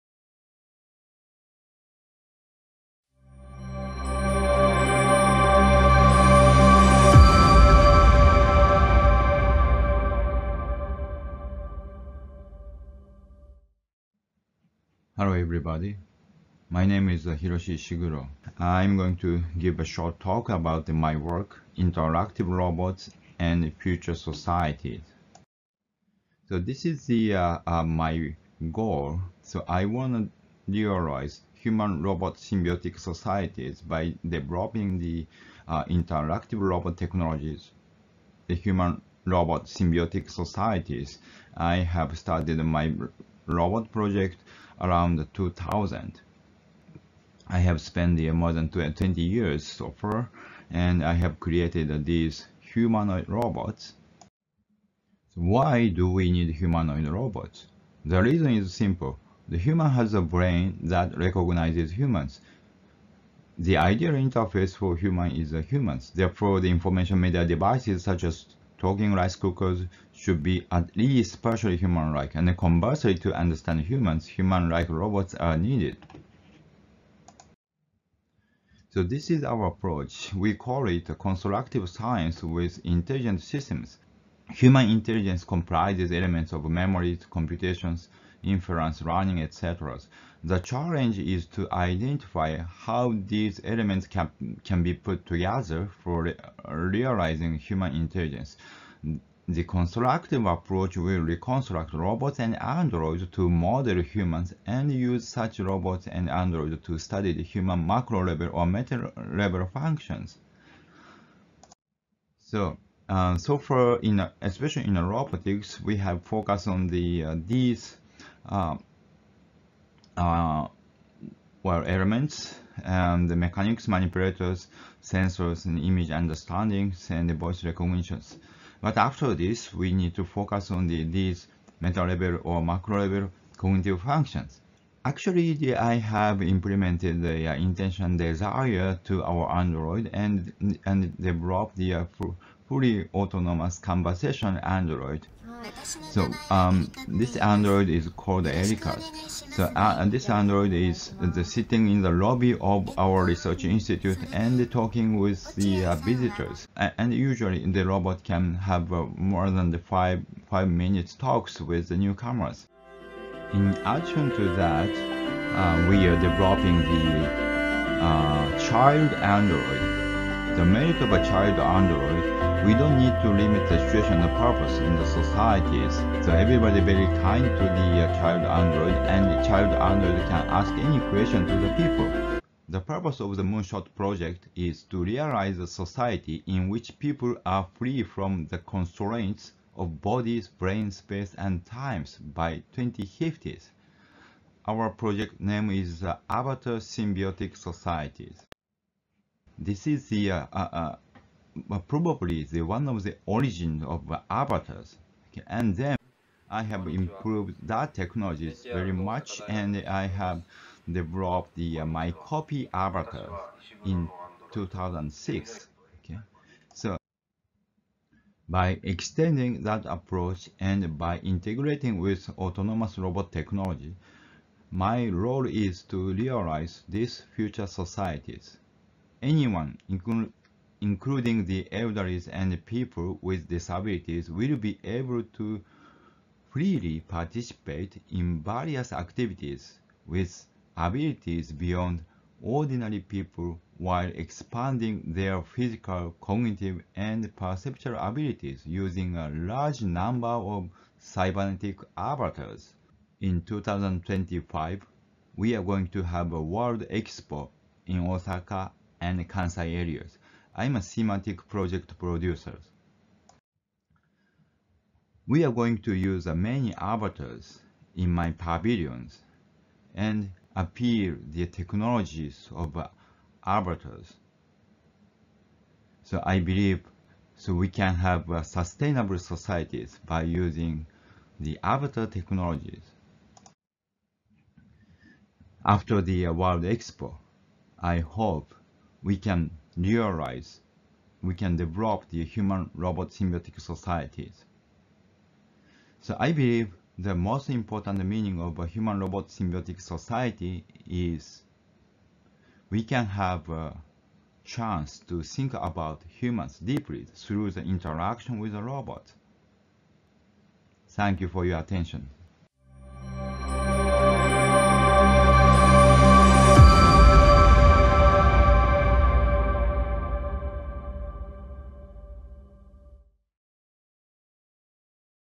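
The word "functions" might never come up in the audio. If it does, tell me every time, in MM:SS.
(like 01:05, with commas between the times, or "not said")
01:49, 02:14.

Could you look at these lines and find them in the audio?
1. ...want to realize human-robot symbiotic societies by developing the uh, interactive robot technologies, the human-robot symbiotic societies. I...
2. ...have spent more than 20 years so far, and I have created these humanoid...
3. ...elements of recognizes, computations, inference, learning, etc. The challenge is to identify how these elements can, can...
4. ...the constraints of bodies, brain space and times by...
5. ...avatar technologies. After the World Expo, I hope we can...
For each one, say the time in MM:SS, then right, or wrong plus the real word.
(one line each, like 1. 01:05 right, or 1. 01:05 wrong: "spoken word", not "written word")
1. 00:29 right
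2. 00:47 right
3. 01:26 wrong: "memories", not "recognizes"
4. 03:08 right
5. 04:41 right.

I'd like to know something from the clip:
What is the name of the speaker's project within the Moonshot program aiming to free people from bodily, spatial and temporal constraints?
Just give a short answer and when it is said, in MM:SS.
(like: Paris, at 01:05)
Avatar Symbiotic Societies, at 03:16.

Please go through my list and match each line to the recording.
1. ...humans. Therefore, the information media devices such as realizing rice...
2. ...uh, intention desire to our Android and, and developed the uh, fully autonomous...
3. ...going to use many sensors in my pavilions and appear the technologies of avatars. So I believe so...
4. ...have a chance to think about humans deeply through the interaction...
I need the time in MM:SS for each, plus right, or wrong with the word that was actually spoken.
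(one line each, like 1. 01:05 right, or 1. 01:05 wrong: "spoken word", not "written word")
1. 01:05 wrong: "talking", not "realizing"
2. 02:17 right
3. 04:25 wrong: "avatars", not "sensors"
4. 05:03 right.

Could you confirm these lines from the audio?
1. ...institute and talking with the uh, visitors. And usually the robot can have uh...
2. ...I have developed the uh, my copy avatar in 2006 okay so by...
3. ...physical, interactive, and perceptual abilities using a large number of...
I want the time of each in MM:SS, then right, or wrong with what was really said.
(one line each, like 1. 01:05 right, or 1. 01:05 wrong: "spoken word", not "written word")
1. 02:33 right
2. 03:29 right
3. 04:05 wrong: "cognitive", not "interactive".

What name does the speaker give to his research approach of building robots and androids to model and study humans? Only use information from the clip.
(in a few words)
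constructive science.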